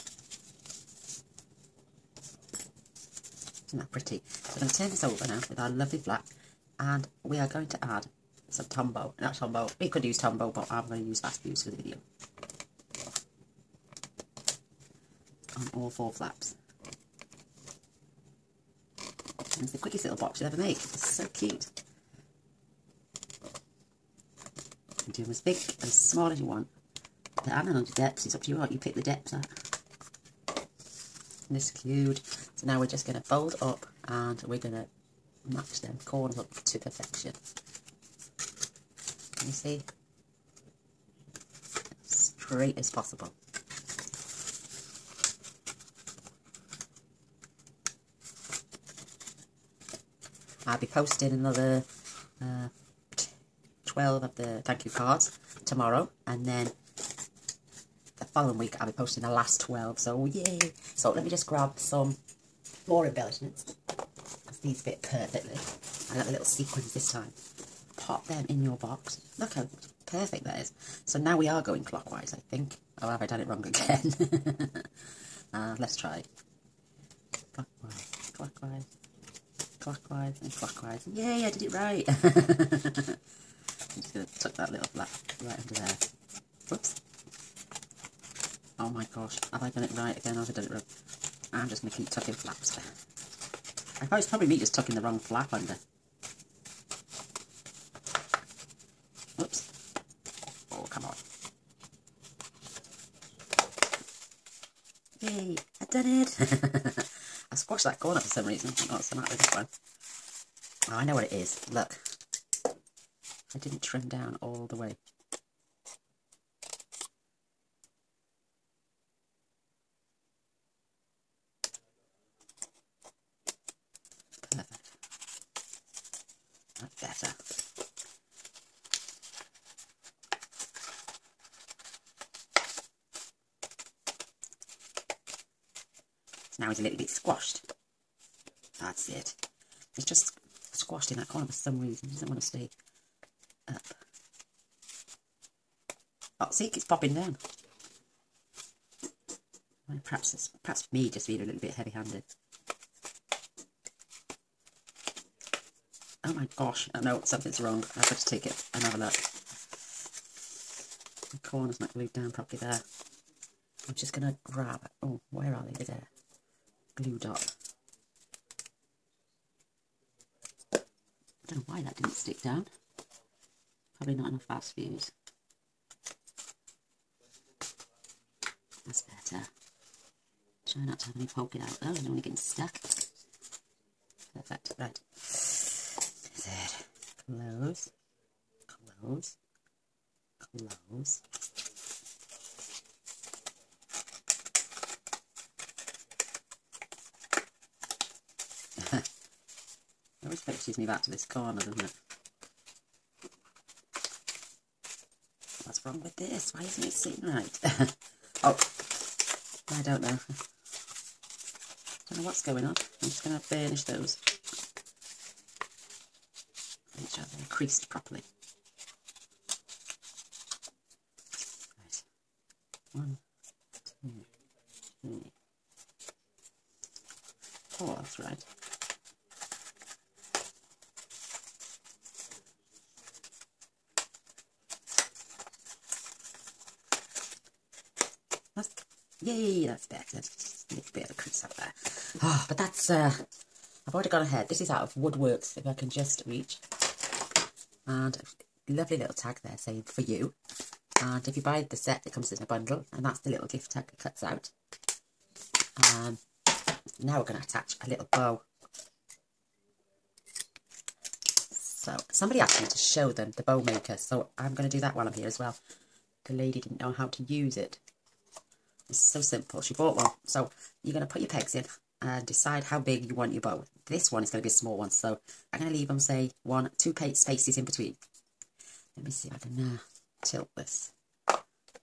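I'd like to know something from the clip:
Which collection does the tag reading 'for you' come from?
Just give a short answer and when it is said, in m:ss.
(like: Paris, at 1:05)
Wood Words, at 4:04.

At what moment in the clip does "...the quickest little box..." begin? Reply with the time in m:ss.
0:19.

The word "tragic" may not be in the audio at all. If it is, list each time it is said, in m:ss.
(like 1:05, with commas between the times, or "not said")
not said.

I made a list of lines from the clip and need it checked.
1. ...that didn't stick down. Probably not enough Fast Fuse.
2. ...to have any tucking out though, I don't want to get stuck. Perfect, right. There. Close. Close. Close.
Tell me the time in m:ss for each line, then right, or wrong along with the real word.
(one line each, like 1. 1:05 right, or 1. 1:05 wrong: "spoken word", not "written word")
1. 2:51 right
2. 3:00 wrong: "poking", not "tucking".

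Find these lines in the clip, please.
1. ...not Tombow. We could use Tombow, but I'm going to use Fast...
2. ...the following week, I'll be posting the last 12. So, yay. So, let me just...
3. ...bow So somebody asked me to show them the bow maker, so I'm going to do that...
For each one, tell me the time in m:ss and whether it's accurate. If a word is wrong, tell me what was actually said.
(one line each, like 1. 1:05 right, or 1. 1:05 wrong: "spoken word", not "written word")
1. 0:09 right
2. 0:58 right
3. 4:18 right.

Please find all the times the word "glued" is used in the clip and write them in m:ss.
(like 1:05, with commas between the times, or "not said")
2:41, 2:46.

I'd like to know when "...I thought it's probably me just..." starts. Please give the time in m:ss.
1:33.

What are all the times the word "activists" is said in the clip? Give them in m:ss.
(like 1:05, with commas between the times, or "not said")
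not said.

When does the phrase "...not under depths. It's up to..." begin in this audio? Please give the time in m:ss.
0:27.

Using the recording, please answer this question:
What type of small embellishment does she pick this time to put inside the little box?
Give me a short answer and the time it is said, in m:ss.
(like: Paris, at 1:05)
Sequins, at 1:06.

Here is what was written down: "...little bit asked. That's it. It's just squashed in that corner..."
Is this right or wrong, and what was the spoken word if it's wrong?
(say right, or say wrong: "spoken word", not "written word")
wrong: "squashed", not "asked".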